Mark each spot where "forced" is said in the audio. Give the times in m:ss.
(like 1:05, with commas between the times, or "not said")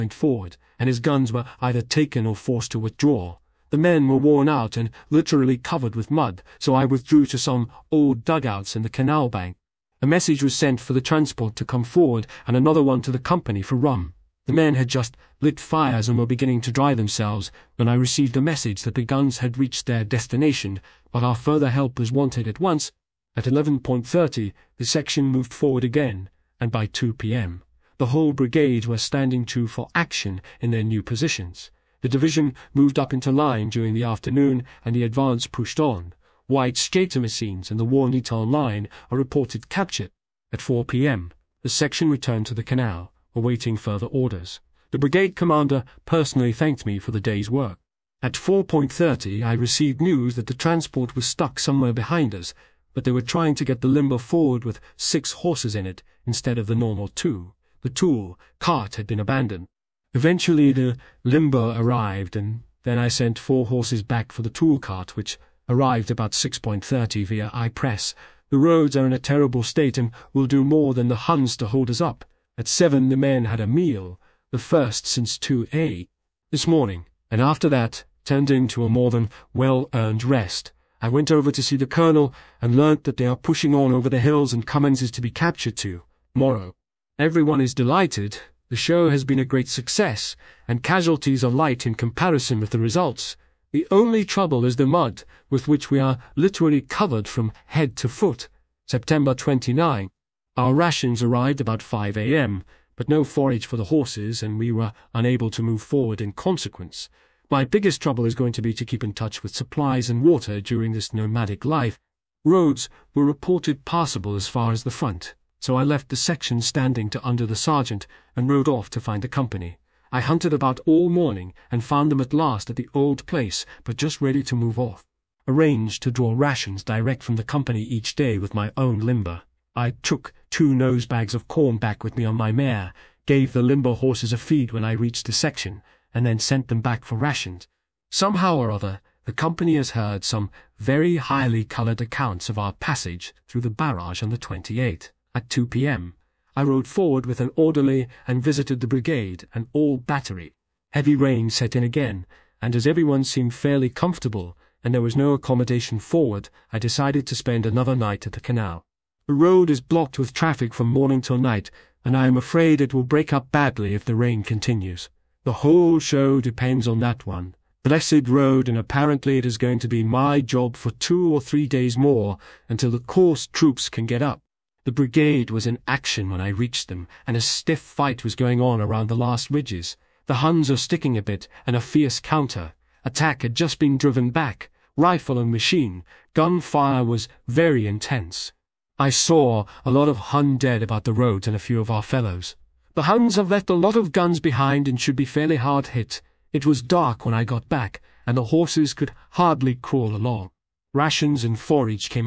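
0:02.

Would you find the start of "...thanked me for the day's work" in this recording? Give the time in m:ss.
0:46.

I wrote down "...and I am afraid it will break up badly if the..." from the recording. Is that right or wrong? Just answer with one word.
right.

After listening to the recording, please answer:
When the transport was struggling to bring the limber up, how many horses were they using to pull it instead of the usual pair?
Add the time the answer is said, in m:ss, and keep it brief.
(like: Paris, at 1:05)
6, at 0:54.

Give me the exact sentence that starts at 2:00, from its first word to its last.
I hunted about all morning and found them at last at the old place, but just ready to move off.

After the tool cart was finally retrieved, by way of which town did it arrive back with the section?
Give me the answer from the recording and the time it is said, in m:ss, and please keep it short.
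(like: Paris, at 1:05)
Ypres, at 1:07.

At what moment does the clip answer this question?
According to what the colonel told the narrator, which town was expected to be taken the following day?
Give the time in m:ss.
1:24.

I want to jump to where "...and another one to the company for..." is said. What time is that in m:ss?
0:12.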